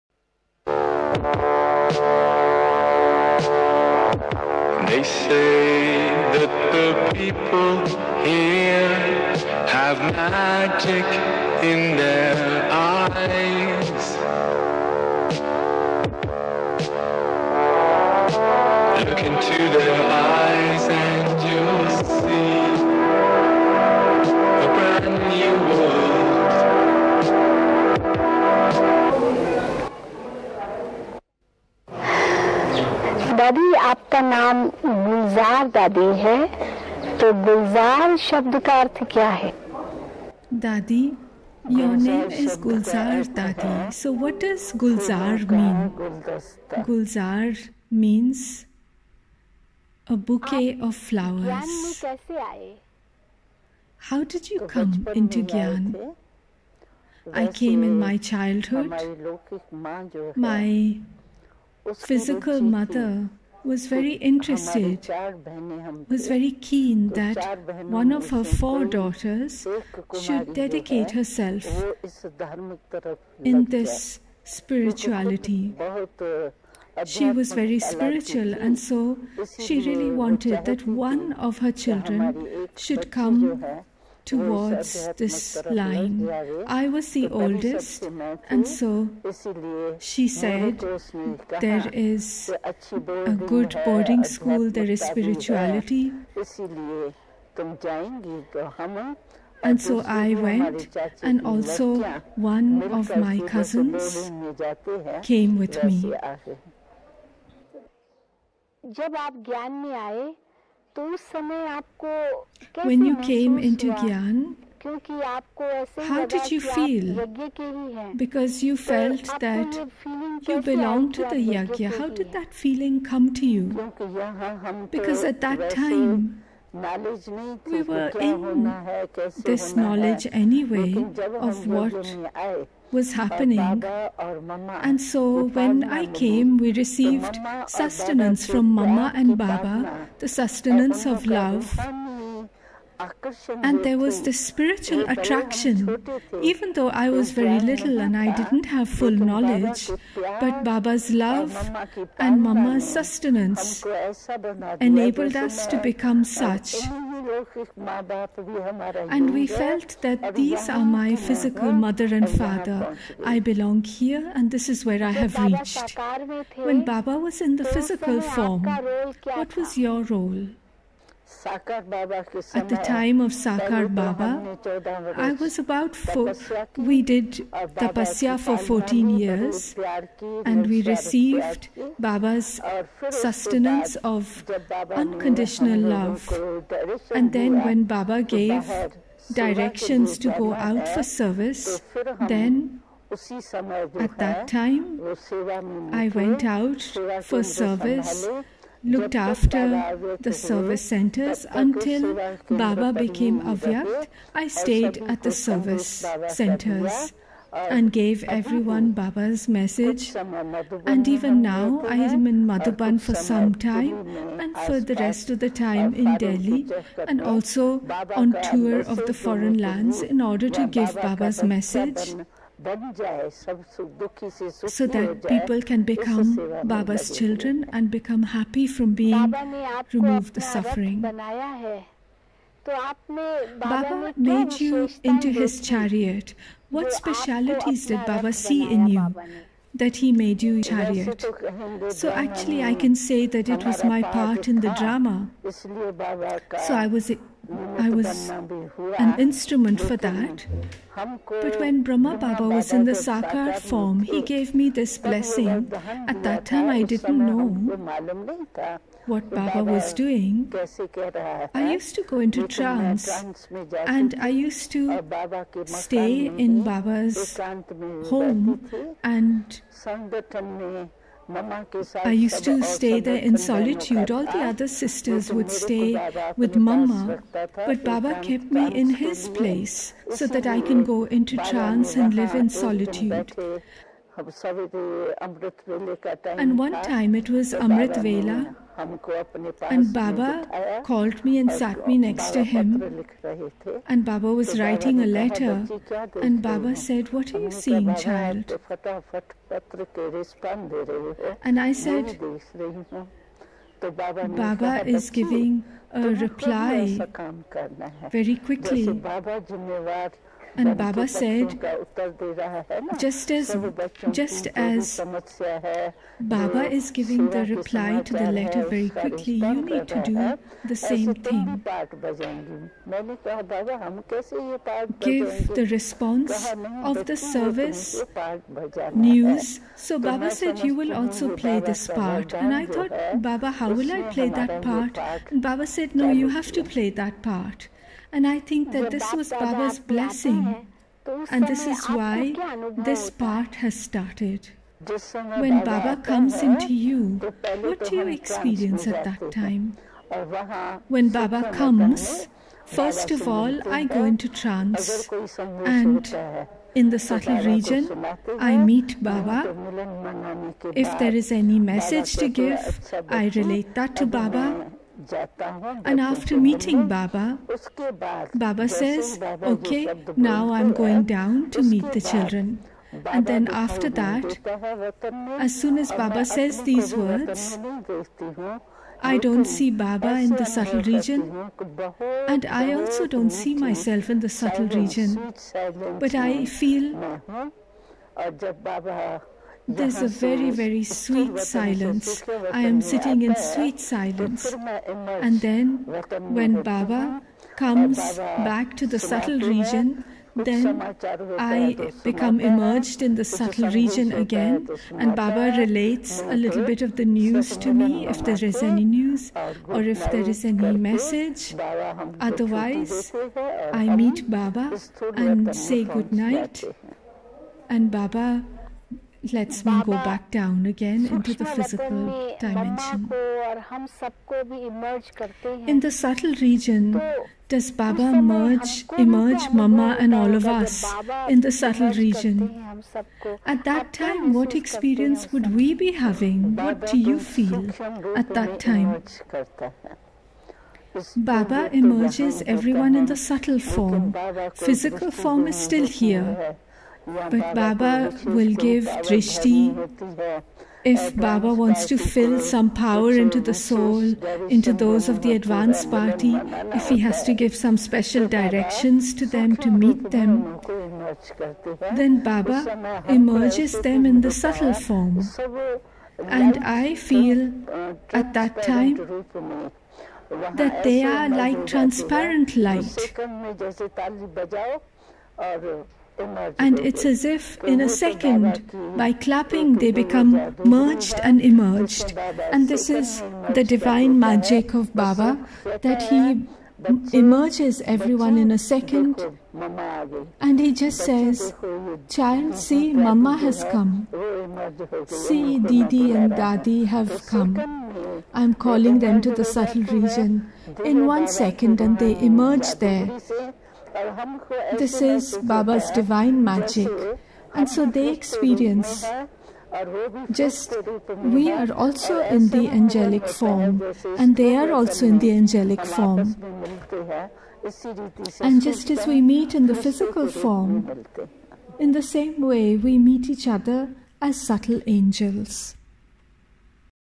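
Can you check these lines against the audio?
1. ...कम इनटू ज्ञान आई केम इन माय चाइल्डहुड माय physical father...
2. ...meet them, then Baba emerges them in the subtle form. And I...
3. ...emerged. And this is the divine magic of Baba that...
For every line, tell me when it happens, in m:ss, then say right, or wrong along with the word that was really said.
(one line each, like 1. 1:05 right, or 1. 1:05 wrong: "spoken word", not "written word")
1. 0:54 wrong: "mother", not "father"
2. 7:39 right
3. 8:01 right.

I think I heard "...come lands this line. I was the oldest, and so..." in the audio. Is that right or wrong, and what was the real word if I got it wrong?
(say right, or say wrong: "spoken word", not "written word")
wrong: "towards", not "lands".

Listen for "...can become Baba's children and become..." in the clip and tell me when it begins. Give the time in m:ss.
3:45.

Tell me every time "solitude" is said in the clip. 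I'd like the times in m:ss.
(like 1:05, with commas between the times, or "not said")
4:33, 4:42.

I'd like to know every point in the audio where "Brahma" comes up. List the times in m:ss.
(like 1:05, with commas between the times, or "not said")
4:11.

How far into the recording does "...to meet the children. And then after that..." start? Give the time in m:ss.
6:11.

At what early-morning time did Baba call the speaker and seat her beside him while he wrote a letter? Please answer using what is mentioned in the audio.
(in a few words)
Amrit Vela.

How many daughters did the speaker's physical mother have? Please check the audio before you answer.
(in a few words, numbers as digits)
4.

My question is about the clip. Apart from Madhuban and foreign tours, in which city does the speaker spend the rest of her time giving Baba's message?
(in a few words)
Delhi.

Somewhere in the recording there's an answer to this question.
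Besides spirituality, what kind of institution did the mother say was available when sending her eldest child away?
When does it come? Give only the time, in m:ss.
1:33.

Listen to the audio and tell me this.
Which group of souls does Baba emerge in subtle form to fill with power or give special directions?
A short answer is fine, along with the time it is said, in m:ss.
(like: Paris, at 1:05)
Advanced party, at 7:35.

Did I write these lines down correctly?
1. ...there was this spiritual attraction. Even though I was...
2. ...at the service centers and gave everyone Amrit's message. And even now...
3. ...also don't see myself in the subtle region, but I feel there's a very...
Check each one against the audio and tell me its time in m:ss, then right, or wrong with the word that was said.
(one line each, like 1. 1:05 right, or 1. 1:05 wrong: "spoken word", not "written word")
1. 2:23 right
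2. 3:25 wrong: "Baba", not "Amrit"
3. 6:22 right.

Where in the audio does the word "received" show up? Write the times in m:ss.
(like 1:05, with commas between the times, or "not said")
2:16, 3:00.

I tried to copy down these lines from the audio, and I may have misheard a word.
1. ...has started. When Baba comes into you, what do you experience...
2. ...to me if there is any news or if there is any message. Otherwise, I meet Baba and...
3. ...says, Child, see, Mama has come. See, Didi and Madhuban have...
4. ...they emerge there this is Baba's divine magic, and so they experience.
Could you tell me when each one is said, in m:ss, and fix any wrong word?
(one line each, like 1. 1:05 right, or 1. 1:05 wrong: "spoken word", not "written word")
1. 5:43 right
2. 6:47 right
3. 8:10 wrong: "Dadi", not "Madhuban"
4. 8:21 right.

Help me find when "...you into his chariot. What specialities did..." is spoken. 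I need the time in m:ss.
3:54.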